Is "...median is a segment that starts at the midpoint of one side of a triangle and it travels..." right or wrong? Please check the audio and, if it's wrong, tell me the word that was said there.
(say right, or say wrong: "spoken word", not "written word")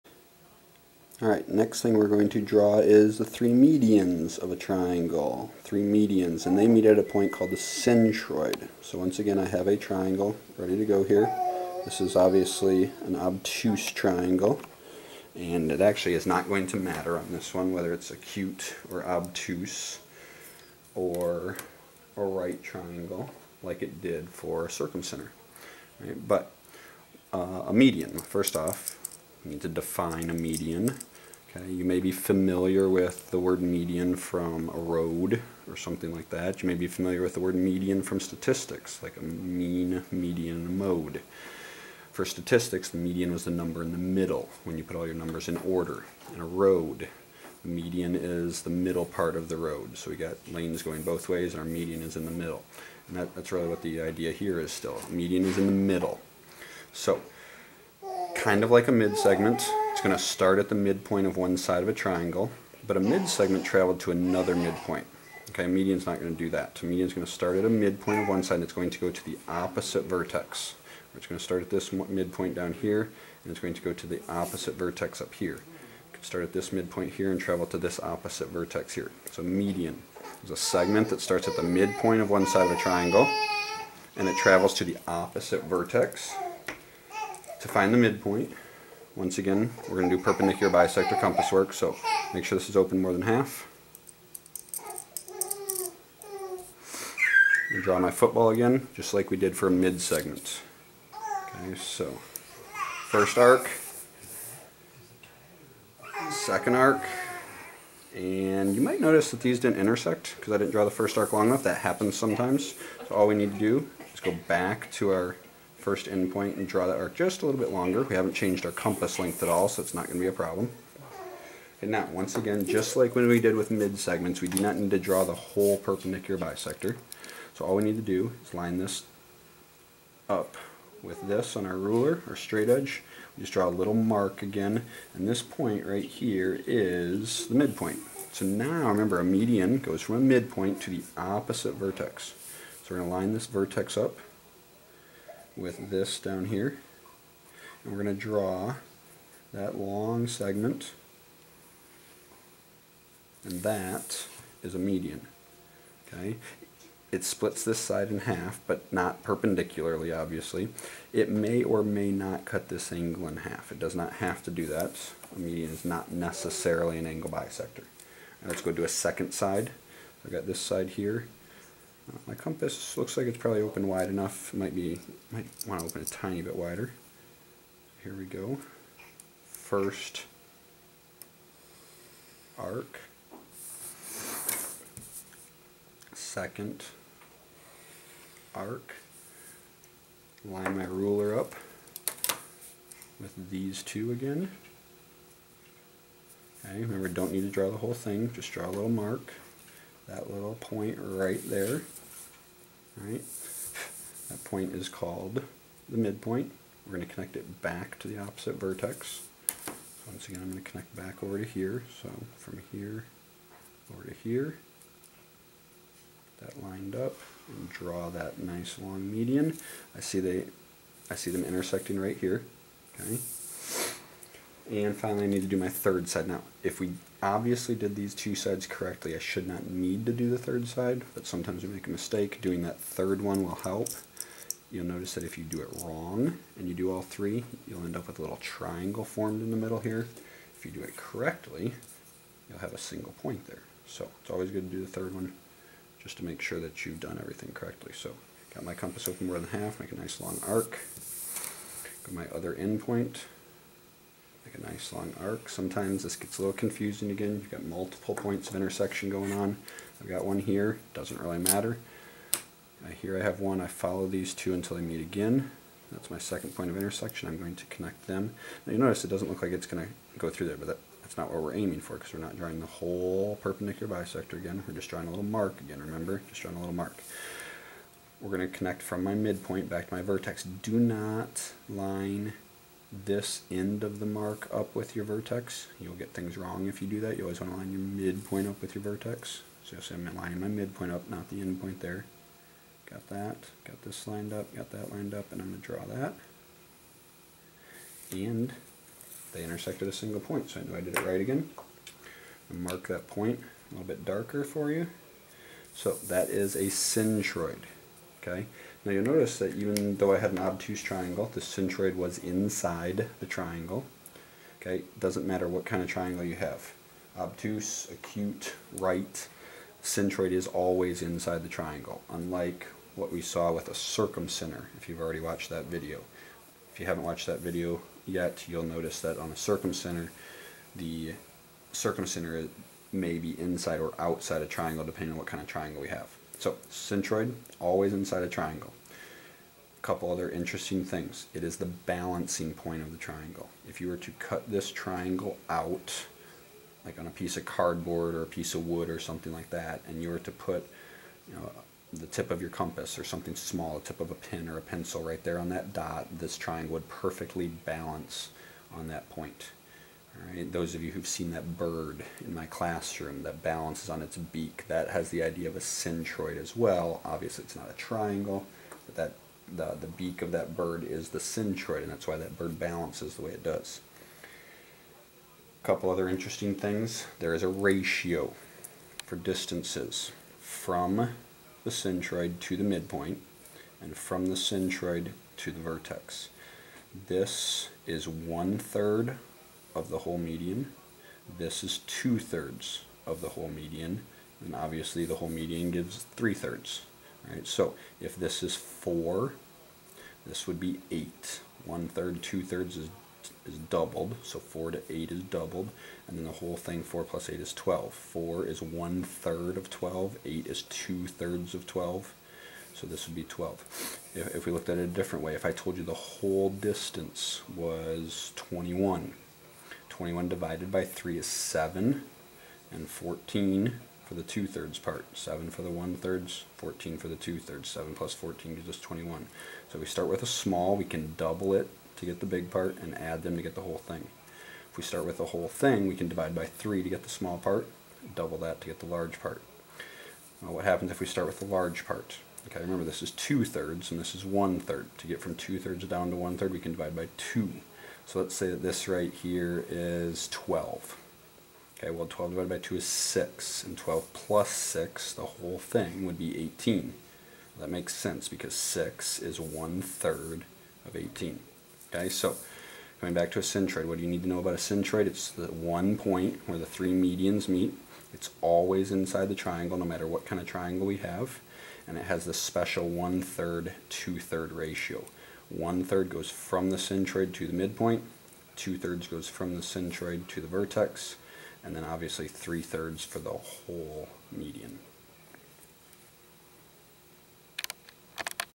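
right.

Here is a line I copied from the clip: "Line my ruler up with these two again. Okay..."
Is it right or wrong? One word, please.
right.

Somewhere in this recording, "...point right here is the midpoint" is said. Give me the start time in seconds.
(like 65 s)
135 s.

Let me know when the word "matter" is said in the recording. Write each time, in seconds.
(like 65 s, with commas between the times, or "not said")
16 s, 261 s, 315 s, 469 s.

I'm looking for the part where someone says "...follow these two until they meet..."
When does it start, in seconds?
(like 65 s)
263 s.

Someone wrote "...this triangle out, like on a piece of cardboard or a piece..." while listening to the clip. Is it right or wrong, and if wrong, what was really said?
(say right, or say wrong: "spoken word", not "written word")
right.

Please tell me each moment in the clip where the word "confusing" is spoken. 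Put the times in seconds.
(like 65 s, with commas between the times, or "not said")
256 s.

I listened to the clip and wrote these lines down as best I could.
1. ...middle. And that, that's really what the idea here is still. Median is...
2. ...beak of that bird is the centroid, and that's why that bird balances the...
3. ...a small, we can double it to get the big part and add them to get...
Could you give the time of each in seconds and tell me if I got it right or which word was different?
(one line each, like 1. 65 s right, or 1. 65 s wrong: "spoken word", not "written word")
1. 52 s right
2. 369 s right
3. 430 s right.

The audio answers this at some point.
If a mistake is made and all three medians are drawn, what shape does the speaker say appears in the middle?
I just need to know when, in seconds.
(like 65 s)
238 s.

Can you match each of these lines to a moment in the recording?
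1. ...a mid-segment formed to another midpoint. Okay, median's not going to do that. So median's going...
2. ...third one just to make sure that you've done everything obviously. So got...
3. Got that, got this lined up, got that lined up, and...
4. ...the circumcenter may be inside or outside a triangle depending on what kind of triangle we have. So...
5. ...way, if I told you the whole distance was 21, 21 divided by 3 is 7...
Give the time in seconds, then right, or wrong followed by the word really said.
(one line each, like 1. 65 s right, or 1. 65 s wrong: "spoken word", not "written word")
1. 62 s wrong: "traveled", not "formed"
2. 244 s wrong: "correctly", not "obviously"
3. 292 s right
4. 330 s right
5. 415 s right.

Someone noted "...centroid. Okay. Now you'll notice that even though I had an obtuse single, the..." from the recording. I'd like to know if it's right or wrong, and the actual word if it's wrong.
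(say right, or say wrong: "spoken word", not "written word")
wrong: "triangle", not "single".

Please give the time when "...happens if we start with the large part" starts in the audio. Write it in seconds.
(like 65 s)
440 s.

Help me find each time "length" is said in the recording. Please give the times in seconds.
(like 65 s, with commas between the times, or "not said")
119 s.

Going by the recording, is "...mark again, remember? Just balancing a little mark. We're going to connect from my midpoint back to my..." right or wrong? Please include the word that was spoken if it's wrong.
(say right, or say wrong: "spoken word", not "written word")
wrong: "drawing", not "balancing".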